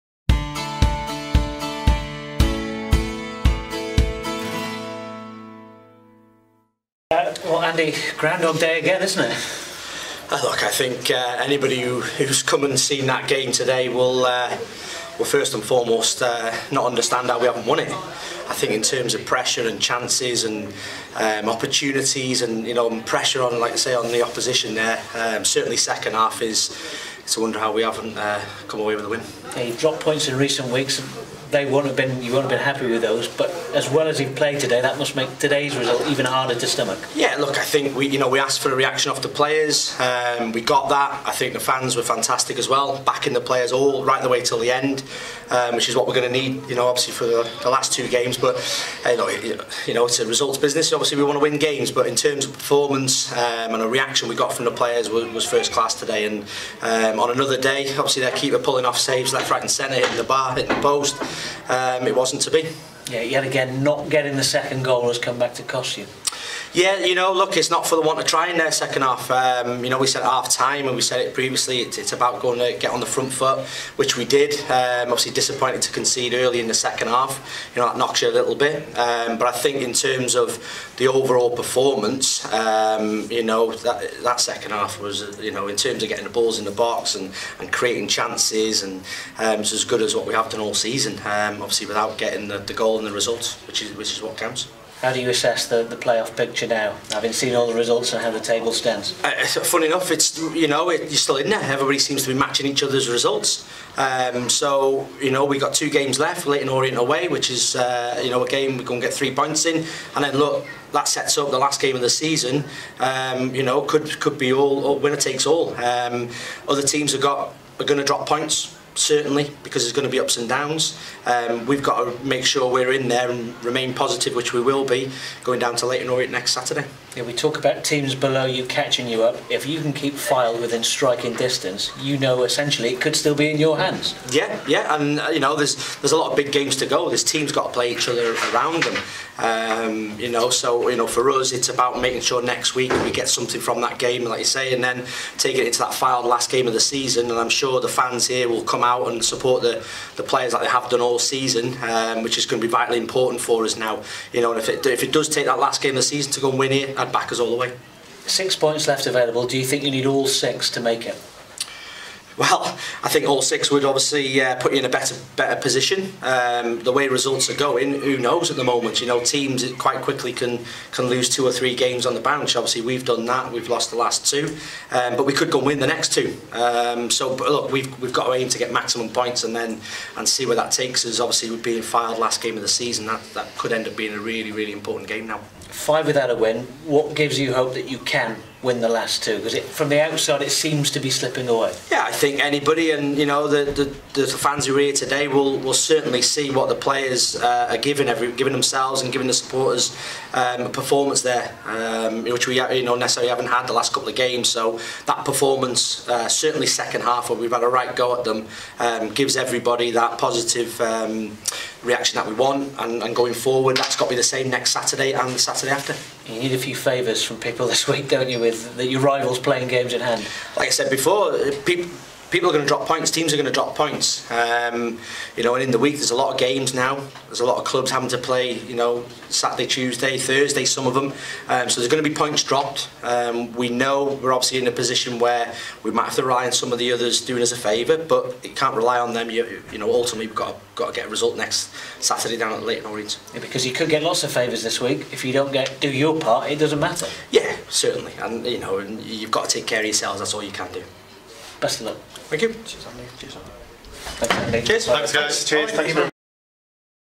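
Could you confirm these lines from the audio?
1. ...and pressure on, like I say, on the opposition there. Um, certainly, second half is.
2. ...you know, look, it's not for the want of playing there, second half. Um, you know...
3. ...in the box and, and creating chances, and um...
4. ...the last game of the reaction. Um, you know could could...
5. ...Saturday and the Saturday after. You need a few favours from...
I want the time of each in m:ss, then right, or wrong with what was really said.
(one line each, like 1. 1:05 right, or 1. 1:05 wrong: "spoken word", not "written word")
1. 0:22 right
2. 1:07 wrong: "trying", not "playing"
3. 1:26 right
4. 1:51 wrong: "season", not "reaction"
5. 3:34 right.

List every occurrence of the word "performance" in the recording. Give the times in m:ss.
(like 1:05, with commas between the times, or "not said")
0:52, 1:21, 3:20, 3:25.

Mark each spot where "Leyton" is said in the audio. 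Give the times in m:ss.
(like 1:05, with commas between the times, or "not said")
2:05, 4:02.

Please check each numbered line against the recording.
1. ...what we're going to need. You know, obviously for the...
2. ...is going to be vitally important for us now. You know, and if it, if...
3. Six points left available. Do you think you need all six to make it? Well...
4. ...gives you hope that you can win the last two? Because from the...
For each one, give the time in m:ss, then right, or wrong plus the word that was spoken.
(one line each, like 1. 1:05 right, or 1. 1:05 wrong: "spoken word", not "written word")
1. 0:45 right
2. 2:32 right
3. 2:38 right
4. 3:07 right.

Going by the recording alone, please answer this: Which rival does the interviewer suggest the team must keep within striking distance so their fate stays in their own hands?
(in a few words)
Fylde.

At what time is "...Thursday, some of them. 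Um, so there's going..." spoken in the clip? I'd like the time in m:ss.
3:50.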